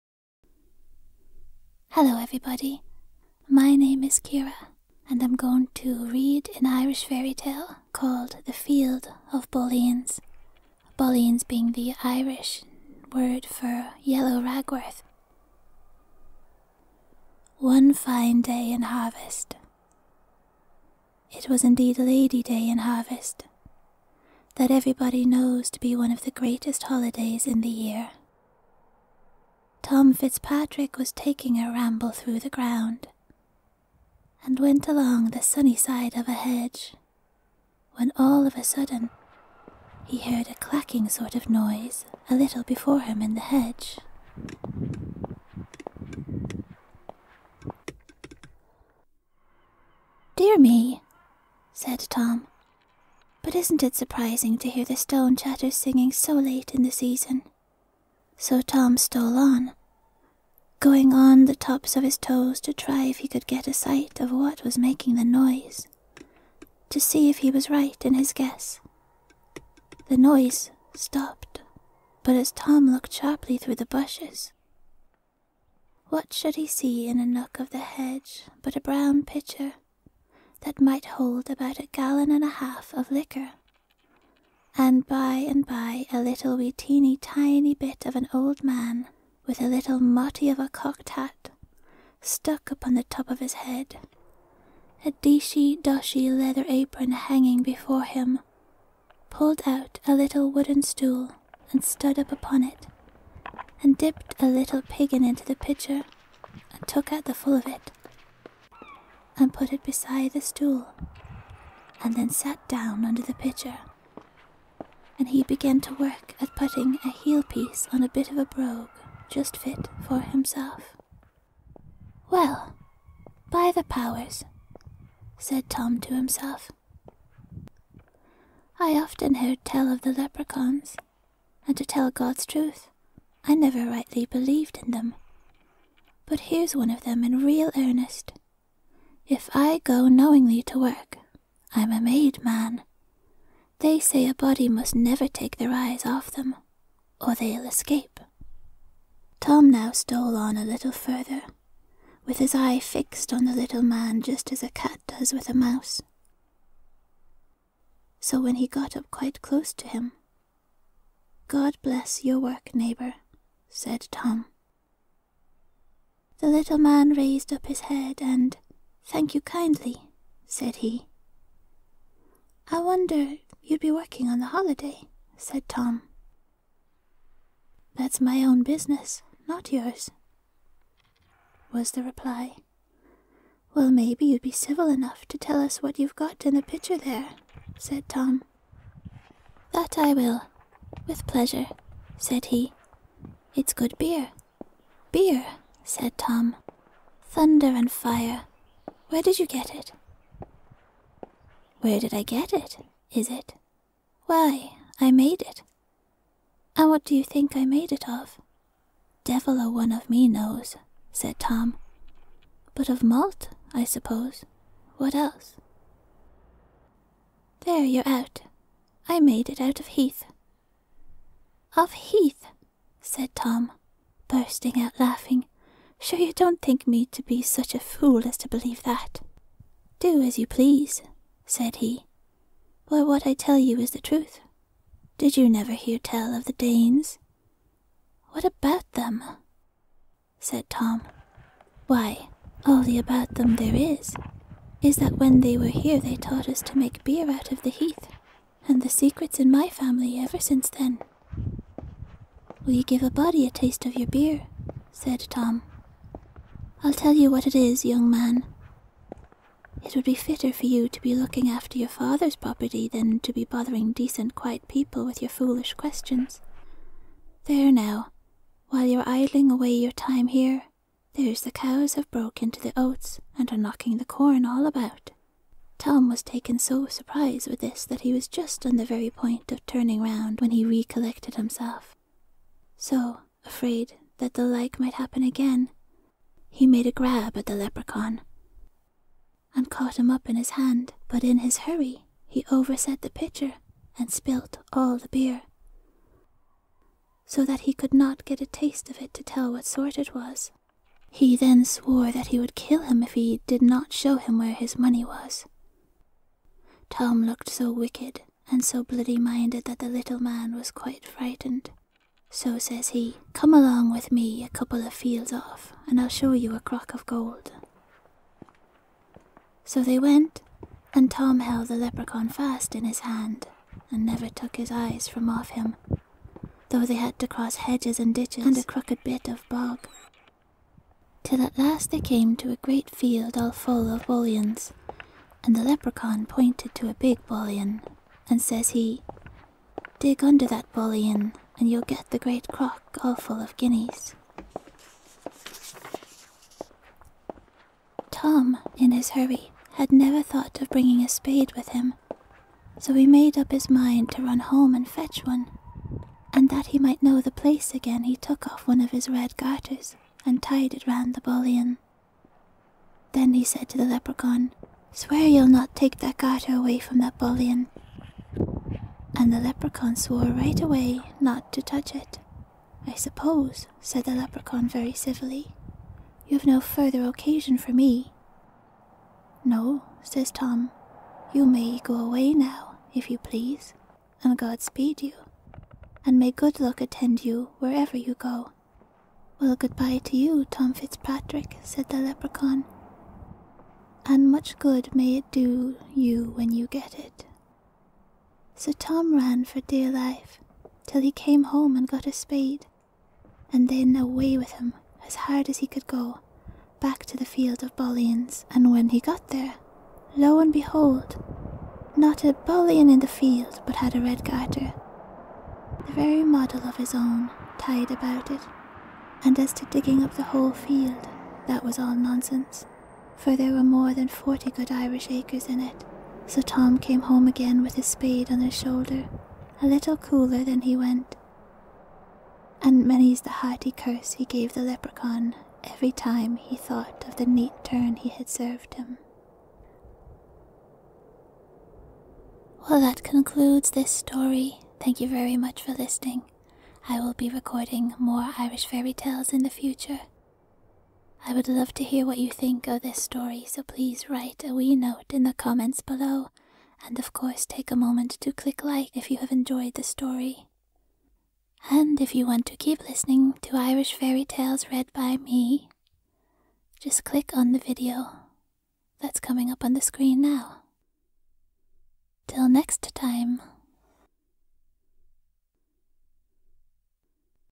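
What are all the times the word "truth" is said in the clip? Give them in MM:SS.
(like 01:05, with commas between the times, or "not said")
02:12, 03:54.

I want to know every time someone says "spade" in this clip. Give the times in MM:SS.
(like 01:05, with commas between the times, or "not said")
05:51, 06:42, 07:07.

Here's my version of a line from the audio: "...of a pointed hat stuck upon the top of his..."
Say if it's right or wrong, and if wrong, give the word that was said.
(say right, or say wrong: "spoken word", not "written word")
wrong: "cocked", not "pointed".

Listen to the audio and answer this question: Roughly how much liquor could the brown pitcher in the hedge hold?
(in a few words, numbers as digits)
About 1.5 gallons.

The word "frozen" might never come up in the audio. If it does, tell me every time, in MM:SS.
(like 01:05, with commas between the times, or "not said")
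not said.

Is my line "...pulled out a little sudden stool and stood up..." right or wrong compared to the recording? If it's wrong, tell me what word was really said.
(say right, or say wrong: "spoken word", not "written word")
wrong: "wooden", not "sudden".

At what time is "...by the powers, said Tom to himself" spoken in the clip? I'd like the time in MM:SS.
02:03.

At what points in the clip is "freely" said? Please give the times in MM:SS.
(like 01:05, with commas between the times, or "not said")
not said.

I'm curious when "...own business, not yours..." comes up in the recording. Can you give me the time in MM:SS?
02:58.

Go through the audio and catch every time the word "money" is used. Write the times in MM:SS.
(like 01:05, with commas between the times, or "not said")
05:04.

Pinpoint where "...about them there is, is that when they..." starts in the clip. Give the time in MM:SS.
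04:02.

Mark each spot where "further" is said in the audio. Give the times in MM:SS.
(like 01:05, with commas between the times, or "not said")
02:30, 06:16.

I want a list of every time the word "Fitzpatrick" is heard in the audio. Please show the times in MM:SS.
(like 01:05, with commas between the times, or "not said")
00:30, 06:30.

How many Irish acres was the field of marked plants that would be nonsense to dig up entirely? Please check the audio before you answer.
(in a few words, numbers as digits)
More than 40.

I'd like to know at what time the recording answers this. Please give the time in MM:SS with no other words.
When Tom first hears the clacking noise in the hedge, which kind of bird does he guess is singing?
00:54.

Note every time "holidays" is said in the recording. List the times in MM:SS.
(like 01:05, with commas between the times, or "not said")
00:26, 02:54.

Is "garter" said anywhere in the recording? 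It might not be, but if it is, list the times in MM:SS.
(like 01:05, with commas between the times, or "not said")
05:59, 06:06, 06:54.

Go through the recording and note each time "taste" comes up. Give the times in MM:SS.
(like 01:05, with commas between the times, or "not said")
04:13, 04:58.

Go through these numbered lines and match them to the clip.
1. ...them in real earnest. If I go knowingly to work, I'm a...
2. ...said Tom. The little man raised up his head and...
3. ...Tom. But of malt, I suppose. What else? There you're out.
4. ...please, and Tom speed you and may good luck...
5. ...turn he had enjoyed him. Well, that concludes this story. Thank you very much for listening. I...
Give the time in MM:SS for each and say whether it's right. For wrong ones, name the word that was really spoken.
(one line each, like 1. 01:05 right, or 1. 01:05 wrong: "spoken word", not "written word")
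1. 02:17 right
2. 02:43 right
3. 03:31 right
4. 06:23 wrong: "God", not "Tom"
5. 07:17 wrong: "served", not "enjoyed".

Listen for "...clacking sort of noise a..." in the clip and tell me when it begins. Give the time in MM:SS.
00:40.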